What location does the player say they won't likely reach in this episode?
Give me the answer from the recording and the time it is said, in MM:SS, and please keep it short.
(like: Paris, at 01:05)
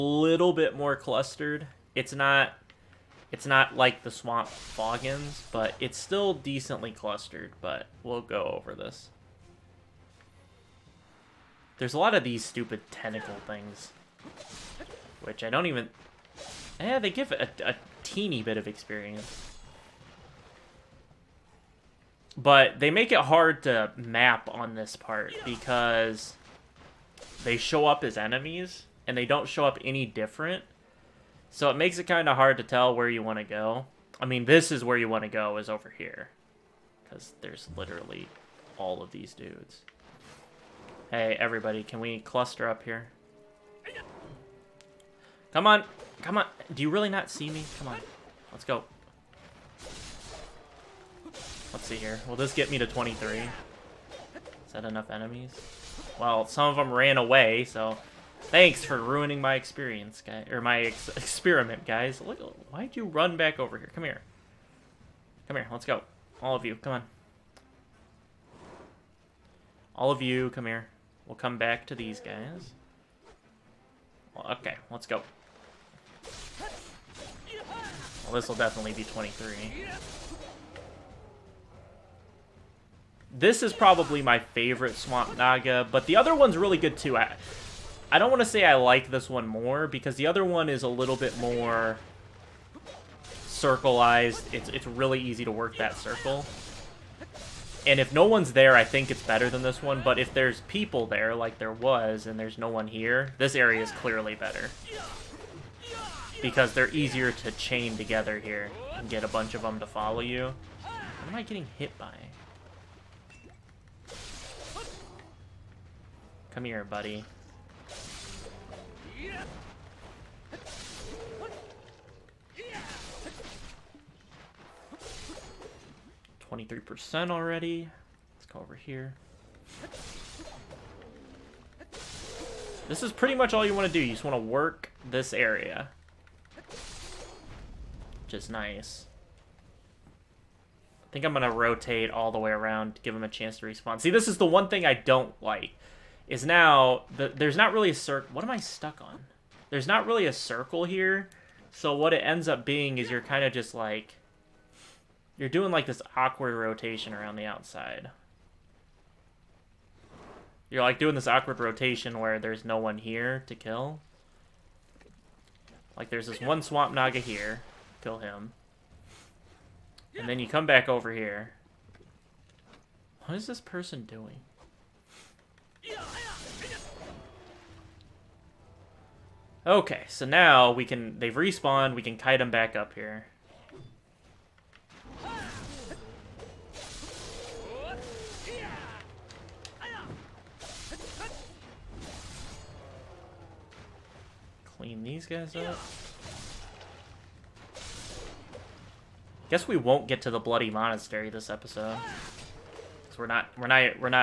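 Bloody Monastery, at 03:20.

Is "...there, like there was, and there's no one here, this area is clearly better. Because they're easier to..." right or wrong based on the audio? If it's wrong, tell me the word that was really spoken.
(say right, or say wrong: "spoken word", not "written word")
right.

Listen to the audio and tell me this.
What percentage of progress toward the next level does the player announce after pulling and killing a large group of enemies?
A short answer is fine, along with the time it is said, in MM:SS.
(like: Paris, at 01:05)
23%, at 02:06.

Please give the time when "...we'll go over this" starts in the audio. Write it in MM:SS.
00:08.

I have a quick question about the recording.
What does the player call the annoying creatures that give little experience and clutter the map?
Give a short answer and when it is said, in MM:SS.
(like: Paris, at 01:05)
Tentacle things, at 00:12.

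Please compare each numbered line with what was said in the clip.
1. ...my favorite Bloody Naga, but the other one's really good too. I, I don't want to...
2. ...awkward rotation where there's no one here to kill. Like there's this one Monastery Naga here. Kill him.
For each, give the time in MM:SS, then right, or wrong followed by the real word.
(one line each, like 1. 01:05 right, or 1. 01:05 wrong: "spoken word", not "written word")
1. 01:24 wrong: "Swamp", not "Bloody"
2. 02:41 wrong: "Swamp", not "Monastery".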